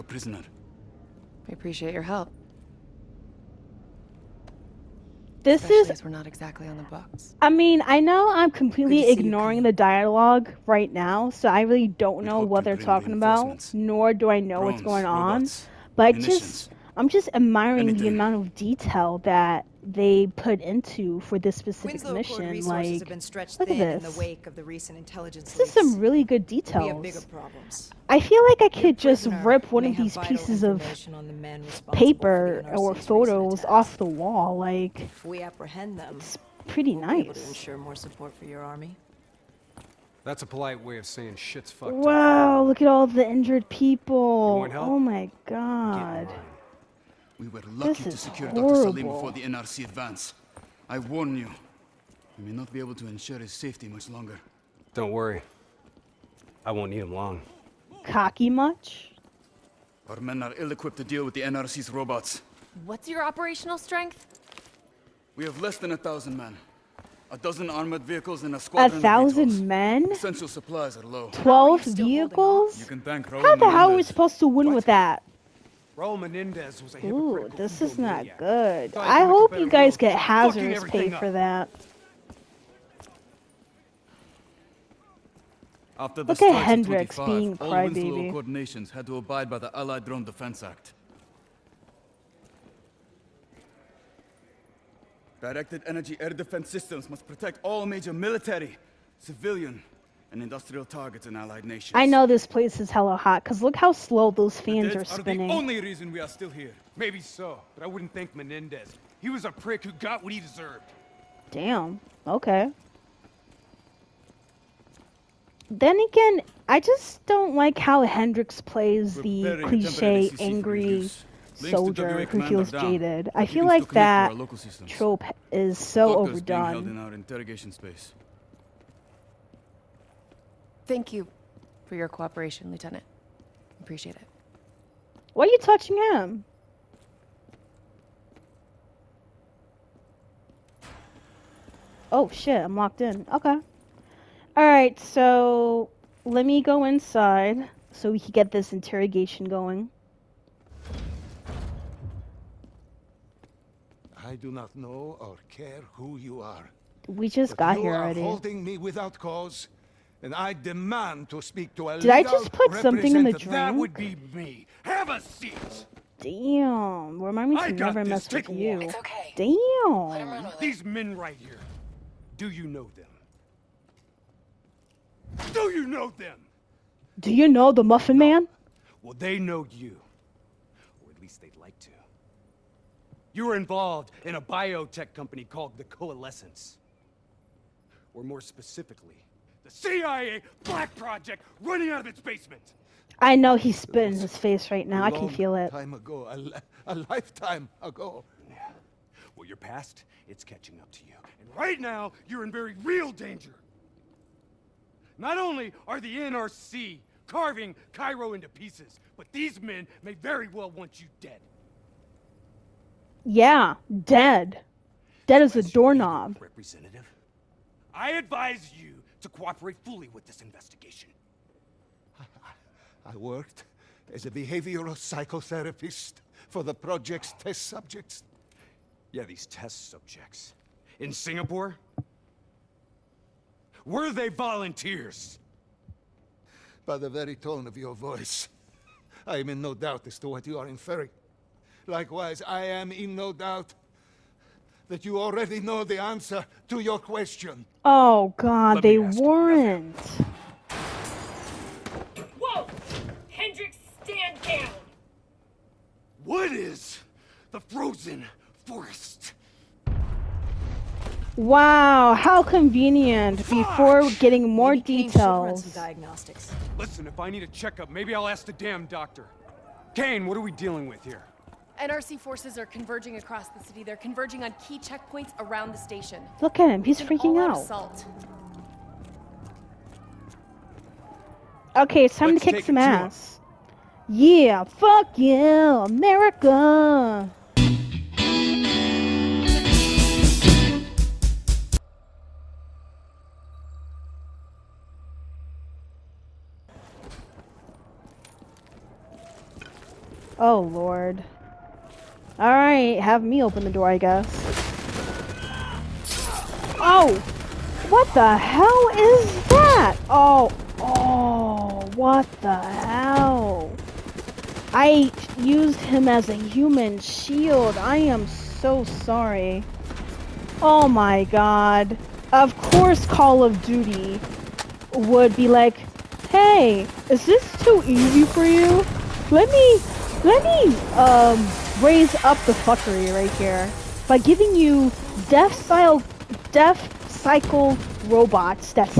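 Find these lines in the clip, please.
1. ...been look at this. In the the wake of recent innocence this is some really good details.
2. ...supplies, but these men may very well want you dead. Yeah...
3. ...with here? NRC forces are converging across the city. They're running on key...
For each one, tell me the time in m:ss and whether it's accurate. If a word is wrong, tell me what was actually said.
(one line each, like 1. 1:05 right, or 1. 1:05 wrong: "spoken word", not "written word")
1. 0:23 wrong: "intelligence", not "innocence"
2. 3:28 wrong: "pieces", not "supplies"
3. 4:30 wrong: "converging", not "running".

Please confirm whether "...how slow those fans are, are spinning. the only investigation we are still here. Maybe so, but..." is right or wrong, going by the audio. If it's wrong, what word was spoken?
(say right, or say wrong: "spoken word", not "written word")
wrong: "reason", not "investigation".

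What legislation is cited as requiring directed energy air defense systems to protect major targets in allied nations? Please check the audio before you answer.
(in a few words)
Allied Drone Defense Act.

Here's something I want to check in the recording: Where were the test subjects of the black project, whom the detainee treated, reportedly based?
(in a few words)
Singapore.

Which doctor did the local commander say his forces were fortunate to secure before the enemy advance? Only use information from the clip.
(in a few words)
Dr. Salim.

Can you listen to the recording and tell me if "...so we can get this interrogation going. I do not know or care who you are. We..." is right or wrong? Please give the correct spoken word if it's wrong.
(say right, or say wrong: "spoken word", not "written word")
right.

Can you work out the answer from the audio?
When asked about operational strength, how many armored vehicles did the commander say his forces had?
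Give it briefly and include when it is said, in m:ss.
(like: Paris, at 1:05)
12, at 1:07.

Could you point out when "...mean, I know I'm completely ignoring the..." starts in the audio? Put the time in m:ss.
0:07.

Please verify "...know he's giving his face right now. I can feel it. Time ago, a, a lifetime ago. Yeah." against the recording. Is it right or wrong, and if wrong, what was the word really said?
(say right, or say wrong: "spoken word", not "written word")
wrong: "spitting", not "giving".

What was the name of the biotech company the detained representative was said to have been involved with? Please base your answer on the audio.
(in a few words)
the Coalescence.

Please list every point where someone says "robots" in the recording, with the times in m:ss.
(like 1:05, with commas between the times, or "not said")
0:15, 1:01, 5:38.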